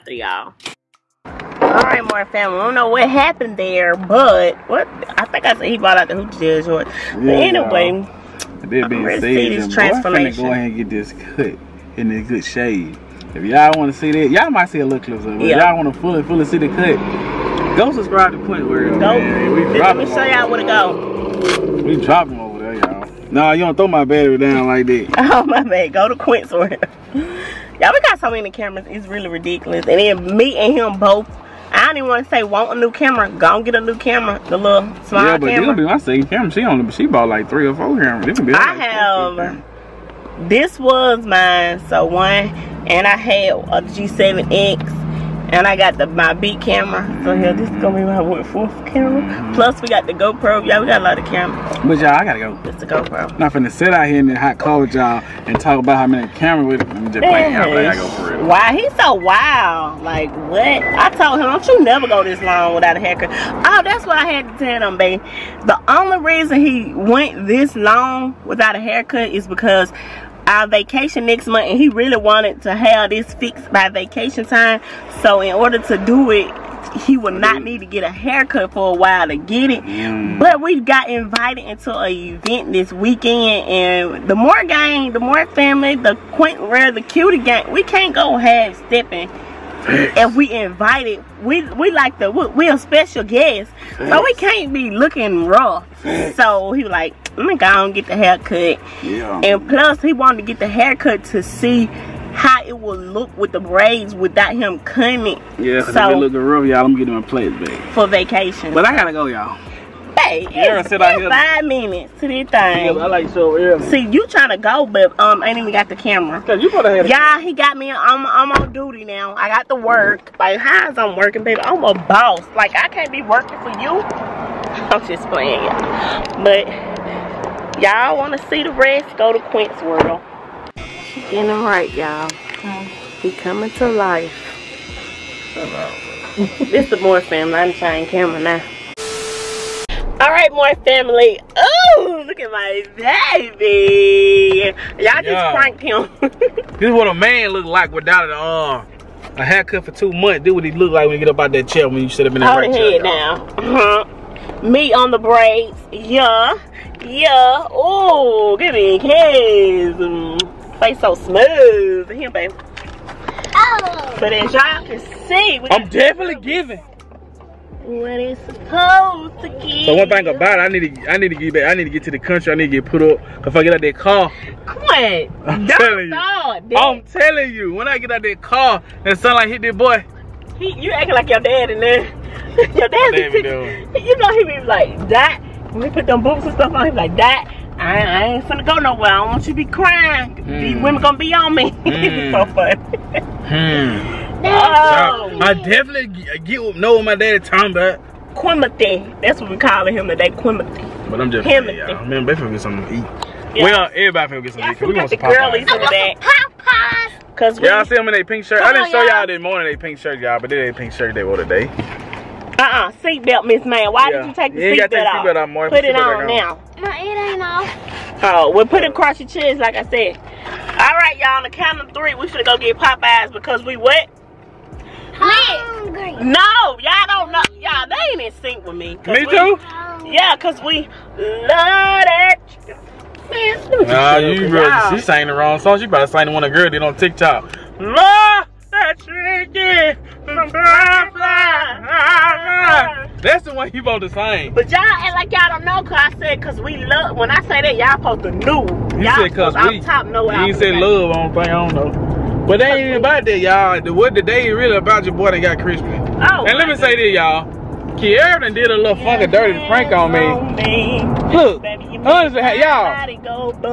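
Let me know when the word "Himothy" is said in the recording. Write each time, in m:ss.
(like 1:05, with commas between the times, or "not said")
3:21.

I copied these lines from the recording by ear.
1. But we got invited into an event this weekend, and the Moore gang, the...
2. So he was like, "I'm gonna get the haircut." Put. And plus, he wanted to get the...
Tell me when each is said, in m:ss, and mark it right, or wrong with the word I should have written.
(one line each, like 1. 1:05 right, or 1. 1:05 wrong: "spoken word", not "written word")
1. 1:20 right
2. 1:36 wrong: "Yeah", not "Put".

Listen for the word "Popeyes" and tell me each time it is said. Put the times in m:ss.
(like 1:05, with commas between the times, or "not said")
3:25, 3:42.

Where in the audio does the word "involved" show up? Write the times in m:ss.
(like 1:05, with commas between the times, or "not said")
not said.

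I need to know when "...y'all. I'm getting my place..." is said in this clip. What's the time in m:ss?
1:46.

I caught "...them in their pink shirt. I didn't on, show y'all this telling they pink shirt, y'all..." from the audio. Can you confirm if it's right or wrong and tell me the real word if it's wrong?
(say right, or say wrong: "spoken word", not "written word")
wrong: "morning", not "telling".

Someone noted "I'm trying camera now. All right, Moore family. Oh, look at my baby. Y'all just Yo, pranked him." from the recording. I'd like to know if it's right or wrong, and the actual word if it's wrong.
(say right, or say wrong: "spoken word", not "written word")
right.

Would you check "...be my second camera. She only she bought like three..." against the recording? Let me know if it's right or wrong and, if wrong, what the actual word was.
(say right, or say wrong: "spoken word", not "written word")
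right.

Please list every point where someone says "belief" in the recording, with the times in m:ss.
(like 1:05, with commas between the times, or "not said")
not said.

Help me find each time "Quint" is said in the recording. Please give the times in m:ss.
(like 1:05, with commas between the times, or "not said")
0:18, 2:09.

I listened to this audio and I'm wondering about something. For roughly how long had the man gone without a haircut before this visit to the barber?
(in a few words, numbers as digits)
2 months.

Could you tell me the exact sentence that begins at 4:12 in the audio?
But they ain't about that, y'all.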